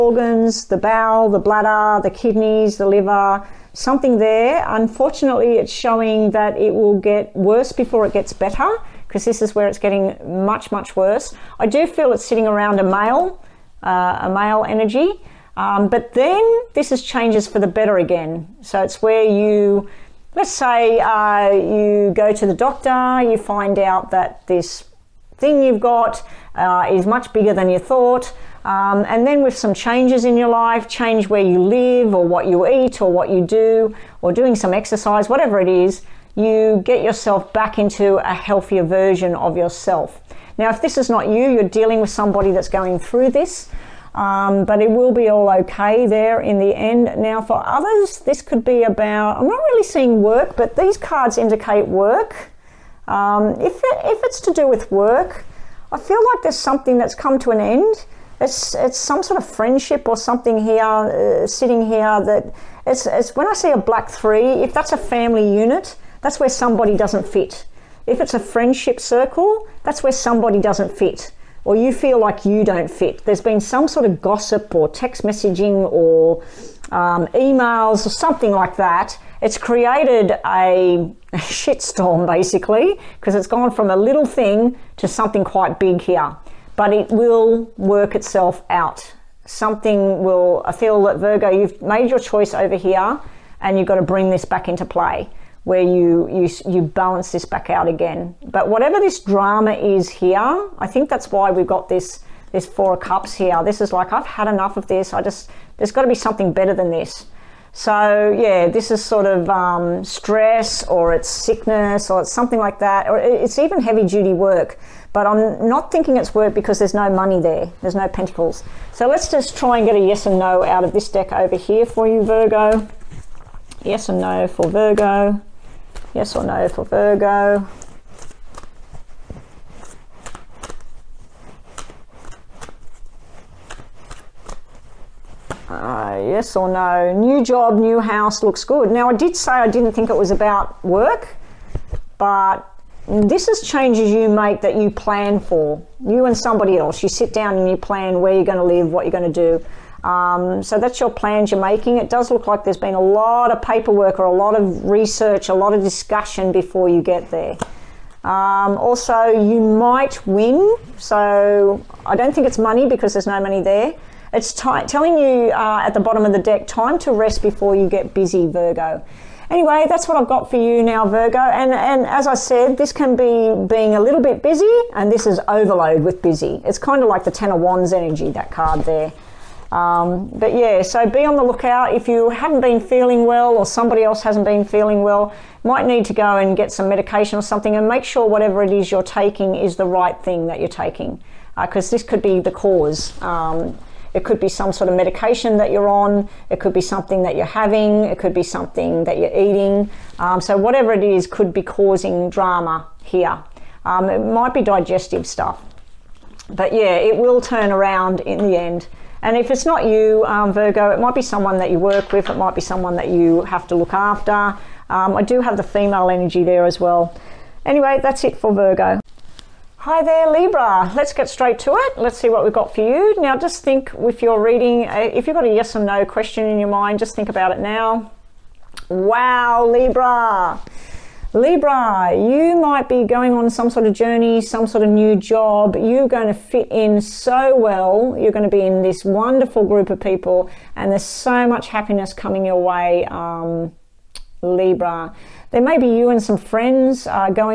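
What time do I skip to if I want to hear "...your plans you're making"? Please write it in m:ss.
2:30.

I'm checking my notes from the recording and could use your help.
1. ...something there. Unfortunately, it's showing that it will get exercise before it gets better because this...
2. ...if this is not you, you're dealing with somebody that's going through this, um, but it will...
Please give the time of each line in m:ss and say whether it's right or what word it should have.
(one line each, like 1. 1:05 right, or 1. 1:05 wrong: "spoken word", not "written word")
1. 0:03 wrong: "worse", not "exercise"
2. 0:40 right.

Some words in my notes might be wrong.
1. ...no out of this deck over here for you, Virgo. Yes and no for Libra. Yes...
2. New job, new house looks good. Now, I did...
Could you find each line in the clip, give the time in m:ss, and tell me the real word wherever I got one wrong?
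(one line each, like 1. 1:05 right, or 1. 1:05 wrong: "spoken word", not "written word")
1. 2:00 wrong: "Virgo", not "Libra"
2. 2:17 right.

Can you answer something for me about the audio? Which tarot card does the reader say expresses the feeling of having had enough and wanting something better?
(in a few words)
Four of Cups.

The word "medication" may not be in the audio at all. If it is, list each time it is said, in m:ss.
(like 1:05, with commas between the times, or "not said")
3:06, 3:14.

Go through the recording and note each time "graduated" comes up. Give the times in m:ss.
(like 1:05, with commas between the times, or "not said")
not said.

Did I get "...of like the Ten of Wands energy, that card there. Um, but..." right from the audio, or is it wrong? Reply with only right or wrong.
right.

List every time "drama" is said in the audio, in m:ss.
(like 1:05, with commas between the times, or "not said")
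1:39, 3:22.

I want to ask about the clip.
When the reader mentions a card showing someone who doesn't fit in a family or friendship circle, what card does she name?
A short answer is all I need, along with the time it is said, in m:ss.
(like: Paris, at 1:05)
black three, at 1:03.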